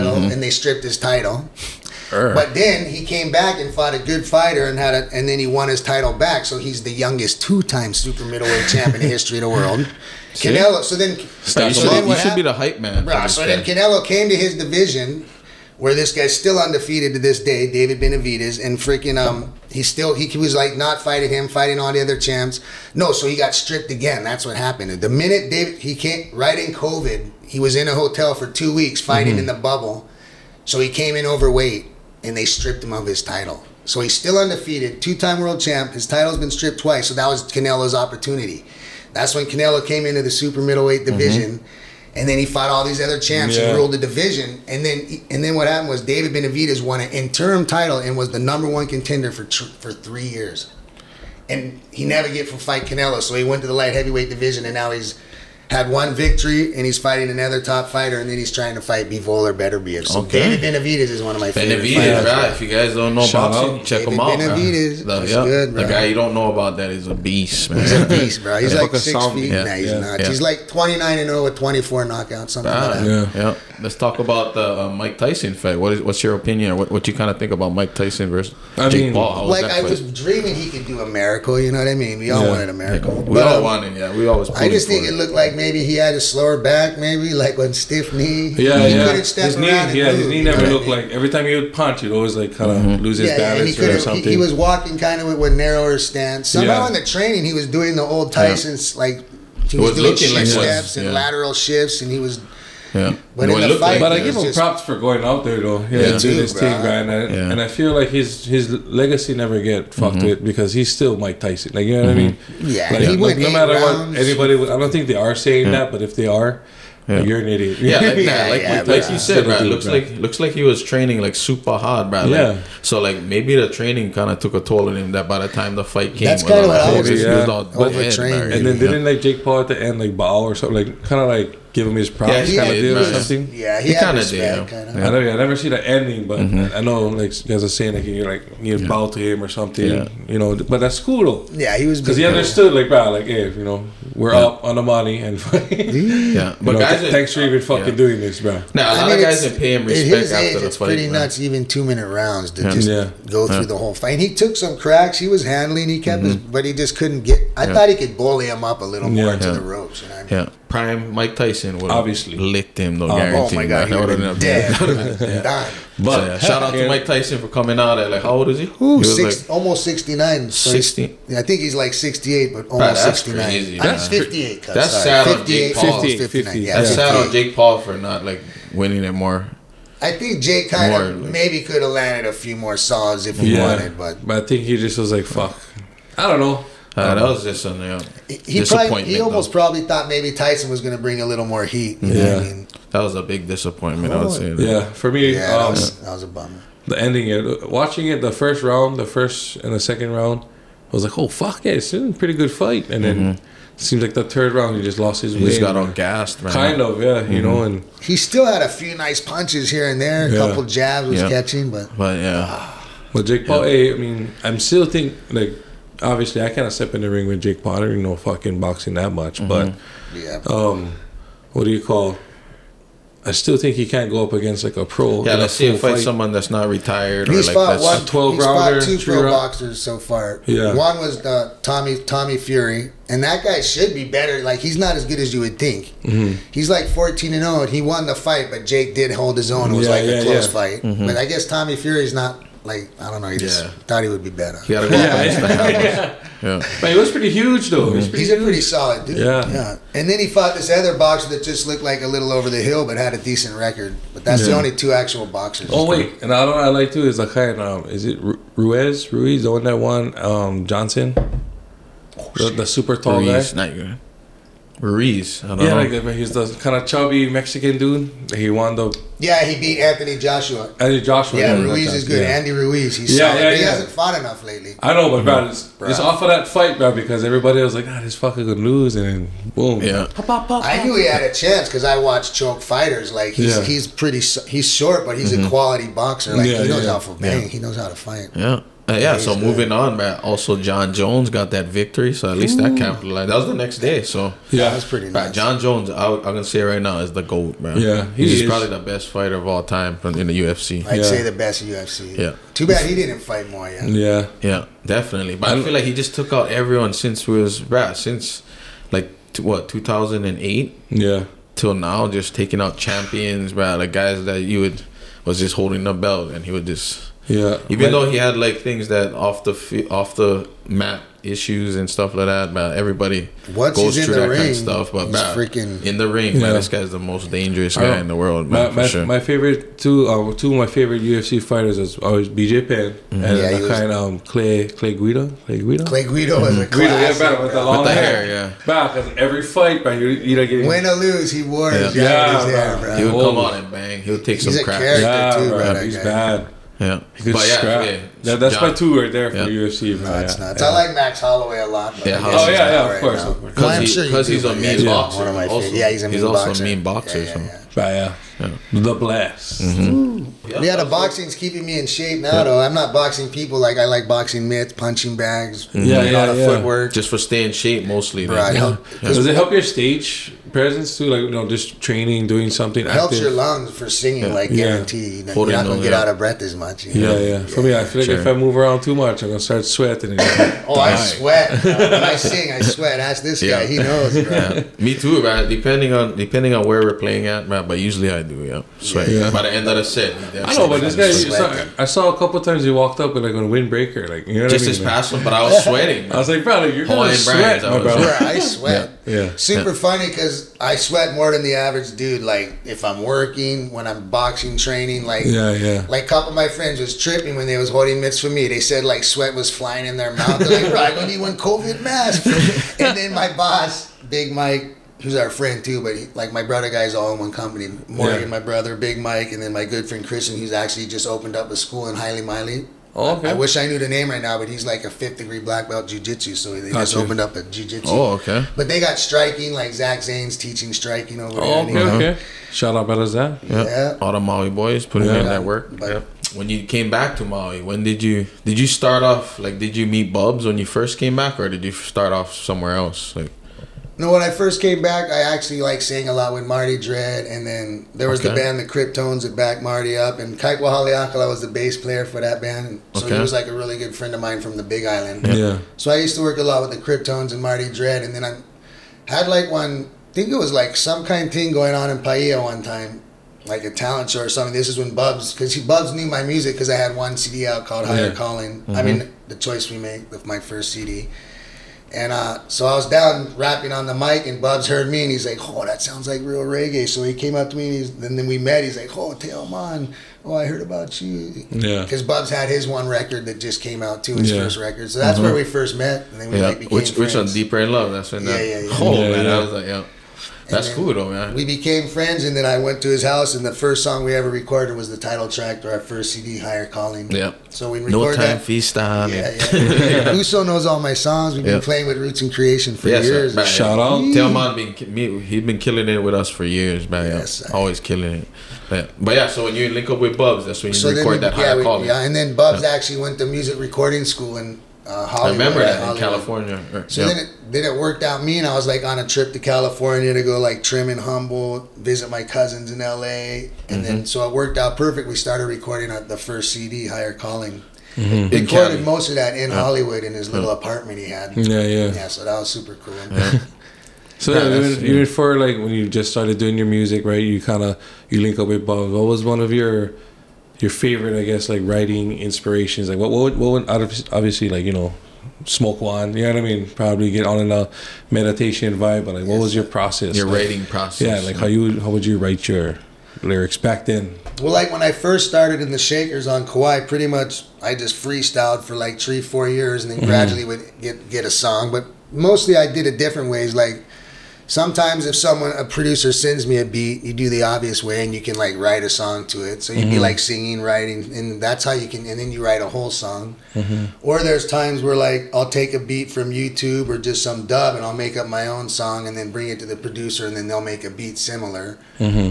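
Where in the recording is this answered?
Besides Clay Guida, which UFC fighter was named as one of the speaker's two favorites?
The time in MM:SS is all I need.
05:32.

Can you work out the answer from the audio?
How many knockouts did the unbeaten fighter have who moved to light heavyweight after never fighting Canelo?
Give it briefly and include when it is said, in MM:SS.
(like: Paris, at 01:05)
24, at 01:11.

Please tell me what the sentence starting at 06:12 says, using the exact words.
It helps your lungs for singing, yeah.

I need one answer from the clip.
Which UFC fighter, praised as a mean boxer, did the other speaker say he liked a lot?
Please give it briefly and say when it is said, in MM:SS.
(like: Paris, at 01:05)
Max Holloway, at 05:50.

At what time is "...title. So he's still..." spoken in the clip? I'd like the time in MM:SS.
00:33.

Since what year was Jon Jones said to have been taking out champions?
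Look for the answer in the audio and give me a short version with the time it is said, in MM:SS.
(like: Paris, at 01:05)
2008, at 05:09.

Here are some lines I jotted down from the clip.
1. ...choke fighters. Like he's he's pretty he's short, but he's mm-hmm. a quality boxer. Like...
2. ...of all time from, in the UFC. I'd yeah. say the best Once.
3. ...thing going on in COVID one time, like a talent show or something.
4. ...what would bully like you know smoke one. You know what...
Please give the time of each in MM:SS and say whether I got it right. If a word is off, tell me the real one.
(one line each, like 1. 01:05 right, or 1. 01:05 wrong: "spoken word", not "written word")
1. 04:42 right
2. 04:59 wrong: "UFC", not "Once"
3. 07:41 wrong: "Paia", not "COVID"
4. 09:03 wrong: "obviously", not "bully".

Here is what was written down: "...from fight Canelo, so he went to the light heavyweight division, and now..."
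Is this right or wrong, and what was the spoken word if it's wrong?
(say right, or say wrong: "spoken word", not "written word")
right.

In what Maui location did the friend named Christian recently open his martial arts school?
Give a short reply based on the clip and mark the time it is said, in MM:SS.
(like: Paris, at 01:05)
Haliimaile, at 07:01.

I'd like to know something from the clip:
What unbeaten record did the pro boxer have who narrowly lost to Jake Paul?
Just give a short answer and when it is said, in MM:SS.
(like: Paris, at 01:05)
14 and 0, at 03:56.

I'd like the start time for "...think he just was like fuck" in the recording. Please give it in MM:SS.
03:04.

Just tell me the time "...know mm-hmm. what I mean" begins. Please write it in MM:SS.
01:52.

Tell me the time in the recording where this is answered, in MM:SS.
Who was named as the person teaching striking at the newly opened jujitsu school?
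07:09.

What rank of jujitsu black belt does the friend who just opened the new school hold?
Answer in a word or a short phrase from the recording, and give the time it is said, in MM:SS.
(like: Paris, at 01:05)
Fifth degree, at 07:04.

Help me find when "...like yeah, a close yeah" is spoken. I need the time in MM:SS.
03:59.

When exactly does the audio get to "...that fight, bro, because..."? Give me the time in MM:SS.
04:36.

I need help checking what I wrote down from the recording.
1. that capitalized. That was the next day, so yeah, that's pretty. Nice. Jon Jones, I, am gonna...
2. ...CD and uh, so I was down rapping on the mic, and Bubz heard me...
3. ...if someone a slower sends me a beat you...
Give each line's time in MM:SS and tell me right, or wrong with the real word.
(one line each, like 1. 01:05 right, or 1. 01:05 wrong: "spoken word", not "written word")
1. 04:52 right
2. 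07:50 right
3. 09:25 wrong: "producer", not "slower".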